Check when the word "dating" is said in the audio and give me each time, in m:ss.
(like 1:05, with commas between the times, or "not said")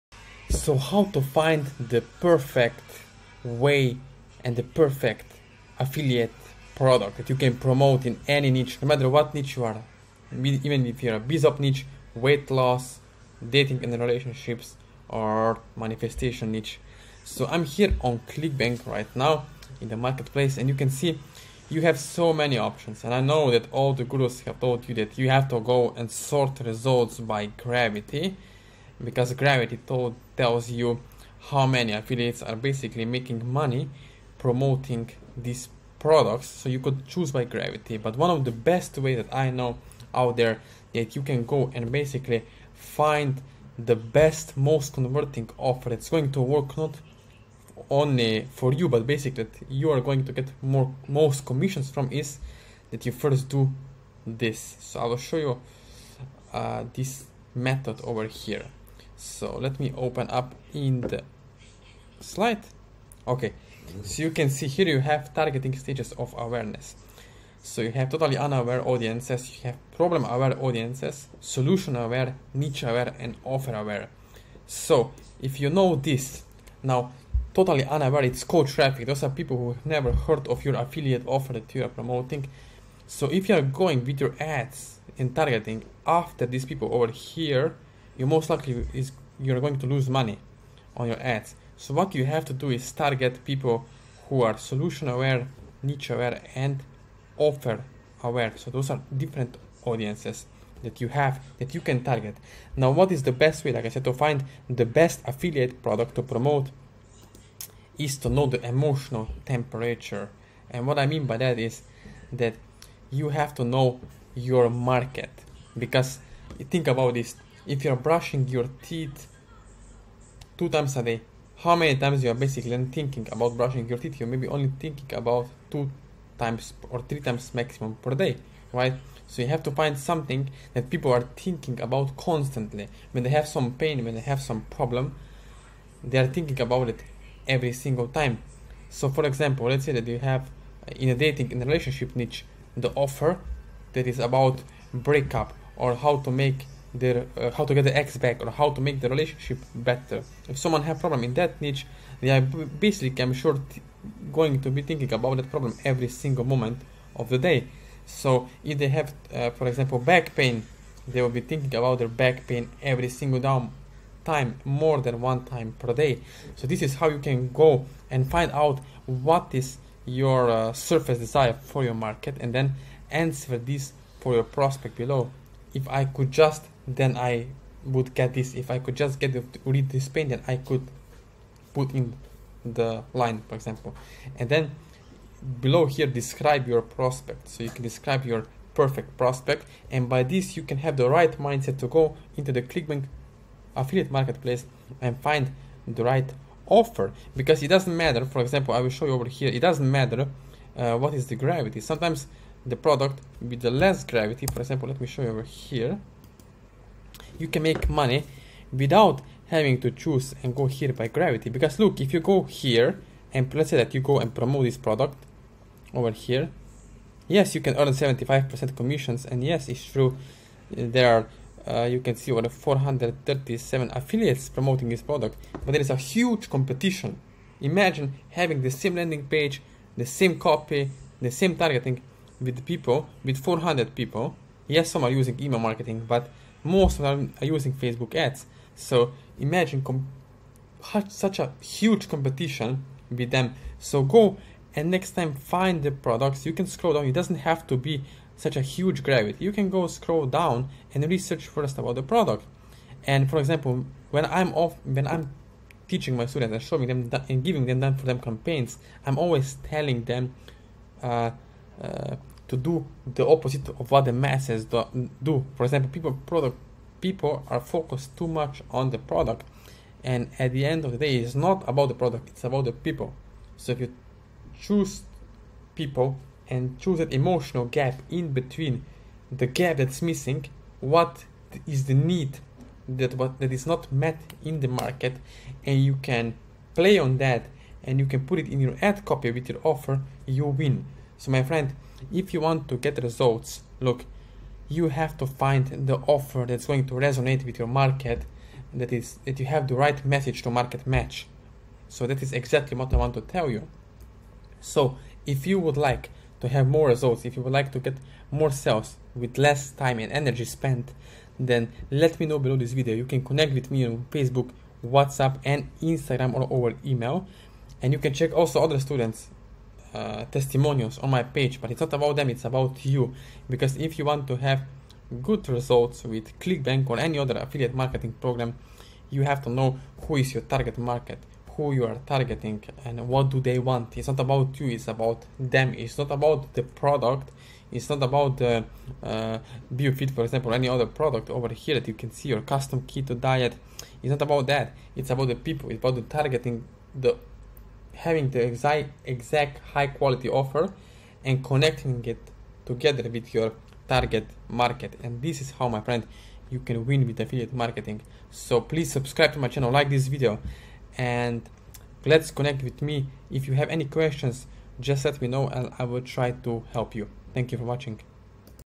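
0:13, 2:21.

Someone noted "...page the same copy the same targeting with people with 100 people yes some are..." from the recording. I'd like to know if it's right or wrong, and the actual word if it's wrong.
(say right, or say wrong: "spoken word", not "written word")
wrong: "400", not "100".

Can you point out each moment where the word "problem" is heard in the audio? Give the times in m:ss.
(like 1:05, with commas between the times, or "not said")
1:09, 2:14, 2:30, 2:35.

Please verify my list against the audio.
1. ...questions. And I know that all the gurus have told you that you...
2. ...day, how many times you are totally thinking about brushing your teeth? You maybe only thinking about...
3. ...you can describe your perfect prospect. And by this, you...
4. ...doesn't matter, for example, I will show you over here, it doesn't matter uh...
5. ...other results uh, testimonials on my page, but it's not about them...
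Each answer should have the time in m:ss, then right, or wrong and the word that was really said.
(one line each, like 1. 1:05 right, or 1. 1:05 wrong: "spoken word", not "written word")
1. 0:22 wrong: "options", not "questions"
2. 2:01 wrong: "basically", not "totally"
3. 3:07 right
4. 3:17 right
5. 5:18 wrong: "students", not "results".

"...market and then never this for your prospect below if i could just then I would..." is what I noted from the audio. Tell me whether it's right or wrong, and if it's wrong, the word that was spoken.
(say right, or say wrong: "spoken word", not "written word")
wrong: "answer", not "never".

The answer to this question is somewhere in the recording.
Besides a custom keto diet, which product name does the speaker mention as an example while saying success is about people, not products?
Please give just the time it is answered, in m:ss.
5:39.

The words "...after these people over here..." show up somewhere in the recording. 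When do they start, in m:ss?
1:26.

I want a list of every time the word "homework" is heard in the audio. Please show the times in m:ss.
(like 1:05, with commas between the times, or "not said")
not said.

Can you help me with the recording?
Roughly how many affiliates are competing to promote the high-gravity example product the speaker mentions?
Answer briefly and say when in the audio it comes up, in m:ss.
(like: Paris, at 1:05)
437, at 3:42.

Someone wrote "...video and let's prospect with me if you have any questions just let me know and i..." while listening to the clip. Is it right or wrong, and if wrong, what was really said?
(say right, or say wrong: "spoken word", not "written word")
wrong: "connect", not "prospect".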